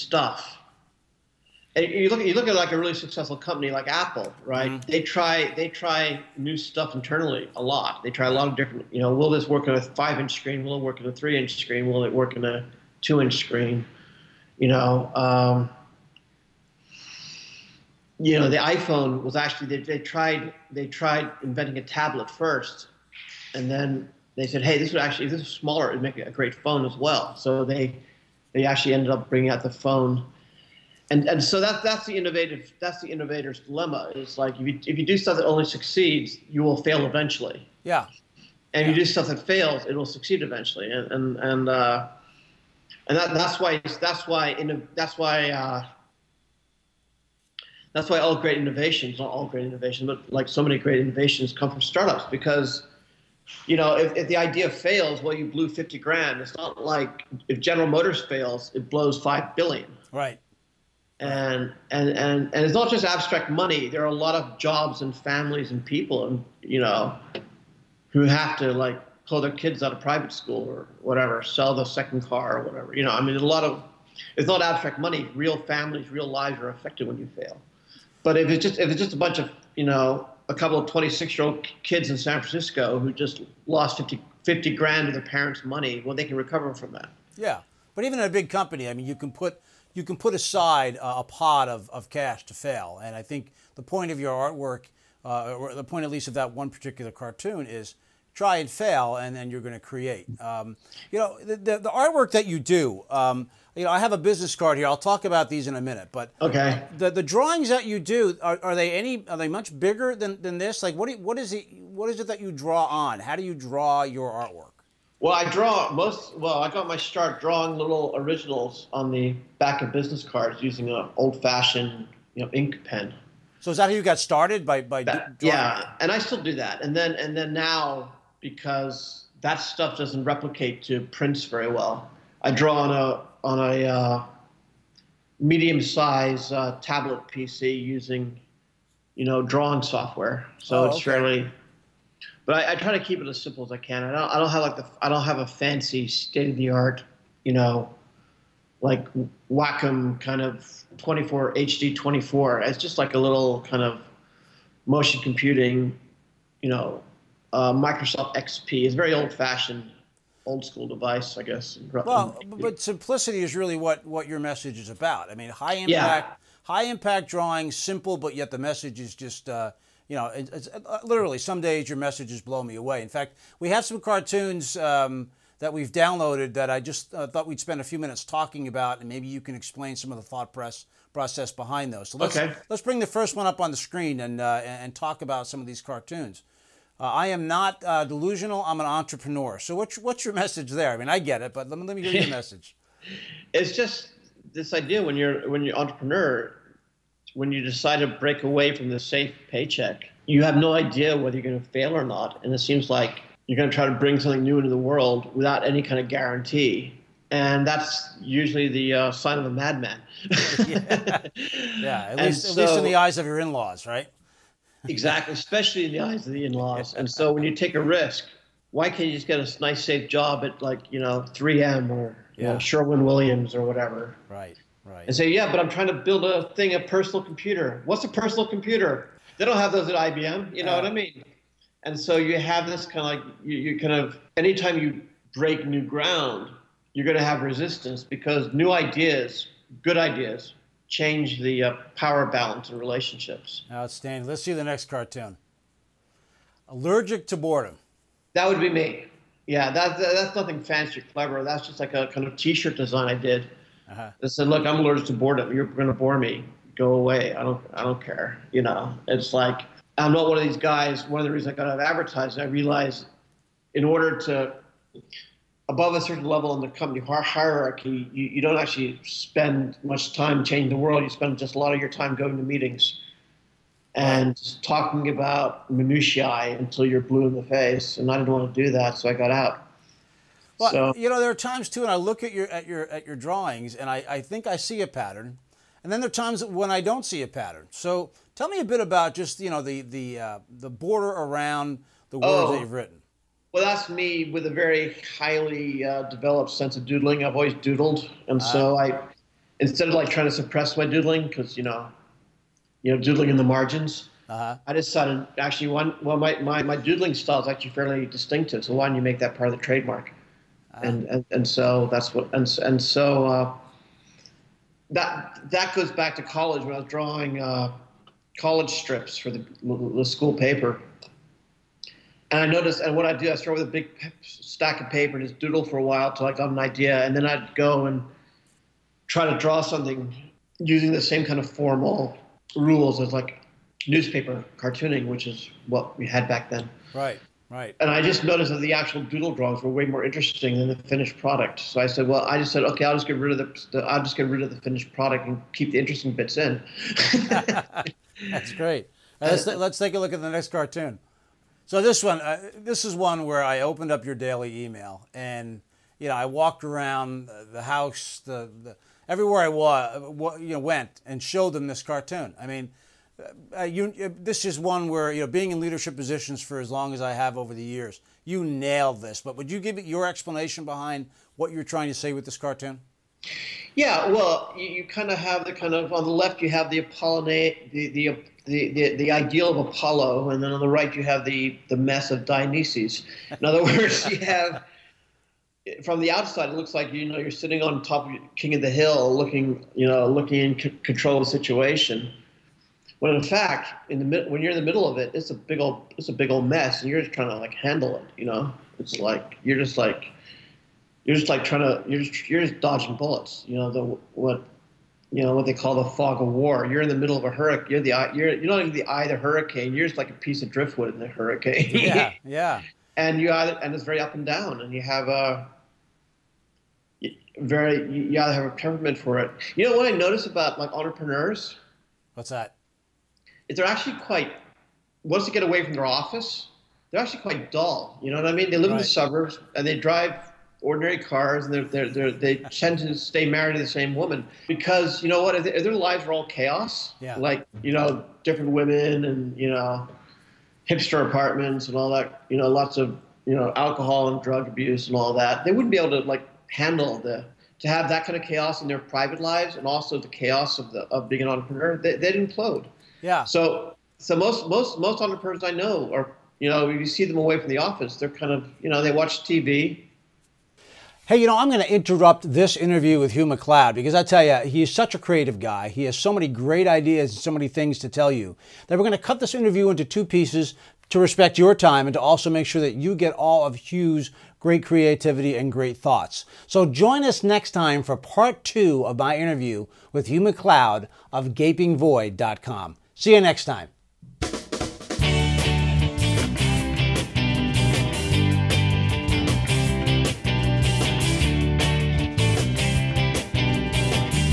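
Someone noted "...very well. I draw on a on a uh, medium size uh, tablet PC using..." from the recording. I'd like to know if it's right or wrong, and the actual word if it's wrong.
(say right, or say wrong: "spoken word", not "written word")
right.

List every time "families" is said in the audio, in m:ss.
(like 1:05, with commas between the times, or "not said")
1:05, 1:15.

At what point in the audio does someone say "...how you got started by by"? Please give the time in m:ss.
2:03.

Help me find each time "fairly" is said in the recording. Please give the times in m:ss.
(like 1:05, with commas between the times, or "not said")
2:21, 5:07.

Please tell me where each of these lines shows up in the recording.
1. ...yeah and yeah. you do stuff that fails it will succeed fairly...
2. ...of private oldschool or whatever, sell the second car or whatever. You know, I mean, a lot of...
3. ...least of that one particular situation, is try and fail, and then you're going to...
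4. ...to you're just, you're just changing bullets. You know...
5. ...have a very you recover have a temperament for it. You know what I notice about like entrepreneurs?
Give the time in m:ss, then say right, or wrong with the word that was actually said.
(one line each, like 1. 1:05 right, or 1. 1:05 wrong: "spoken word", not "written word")
1. 0:37 wrong: "eventually", not "fairly"
2. 1:09 wrong: "school", not "oldschool"
3. 1:36 wrong: "cartoon", not "situation"
4. 6:41 wrong: "dodging", not "changing"
5. 6:54 wrong: "either", not "recover".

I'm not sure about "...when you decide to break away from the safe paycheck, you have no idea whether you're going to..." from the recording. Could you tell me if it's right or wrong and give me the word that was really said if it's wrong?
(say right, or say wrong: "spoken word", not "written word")
right.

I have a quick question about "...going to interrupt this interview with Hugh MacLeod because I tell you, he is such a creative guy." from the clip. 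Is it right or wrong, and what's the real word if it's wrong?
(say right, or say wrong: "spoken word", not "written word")
right.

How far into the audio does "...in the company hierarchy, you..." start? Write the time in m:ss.
4:26.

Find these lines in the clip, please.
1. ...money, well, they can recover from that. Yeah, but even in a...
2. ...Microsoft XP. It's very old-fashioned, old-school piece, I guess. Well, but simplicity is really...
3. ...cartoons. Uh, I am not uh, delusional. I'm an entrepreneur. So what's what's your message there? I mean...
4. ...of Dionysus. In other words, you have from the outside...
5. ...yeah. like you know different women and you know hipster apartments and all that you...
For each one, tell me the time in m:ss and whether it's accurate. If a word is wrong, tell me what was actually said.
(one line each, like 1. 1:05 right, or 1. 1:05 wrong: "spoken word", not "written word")
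1. 1:25 right
2. 2:37 wrong: "device", not "piece"
3. 3:05 right
4. 6:22 right
5. 7:17 right.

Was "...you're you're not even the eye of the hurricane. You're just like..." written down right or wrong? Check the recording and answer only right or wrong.
right.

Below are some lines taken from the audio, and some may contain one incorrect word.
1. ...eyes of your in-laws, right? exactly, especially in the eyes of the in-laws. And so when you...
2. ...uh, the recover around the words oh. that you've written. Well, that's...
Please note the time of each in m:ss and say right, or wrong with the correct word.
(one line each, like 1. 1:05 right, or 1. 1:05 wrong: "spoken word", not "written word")
1. 3:32 right
2. 4:50 wrong: "border", not "recover".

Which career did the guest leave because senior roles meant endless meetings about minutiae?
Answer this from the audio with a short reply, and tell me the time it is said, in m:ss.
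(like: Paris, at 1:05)
advertising, at 4:21.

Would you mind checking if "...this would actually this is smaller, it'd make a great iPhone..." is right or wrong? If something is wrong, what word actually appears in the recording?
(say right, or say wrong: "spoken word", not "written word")
wrong: "phone", not "iPhone".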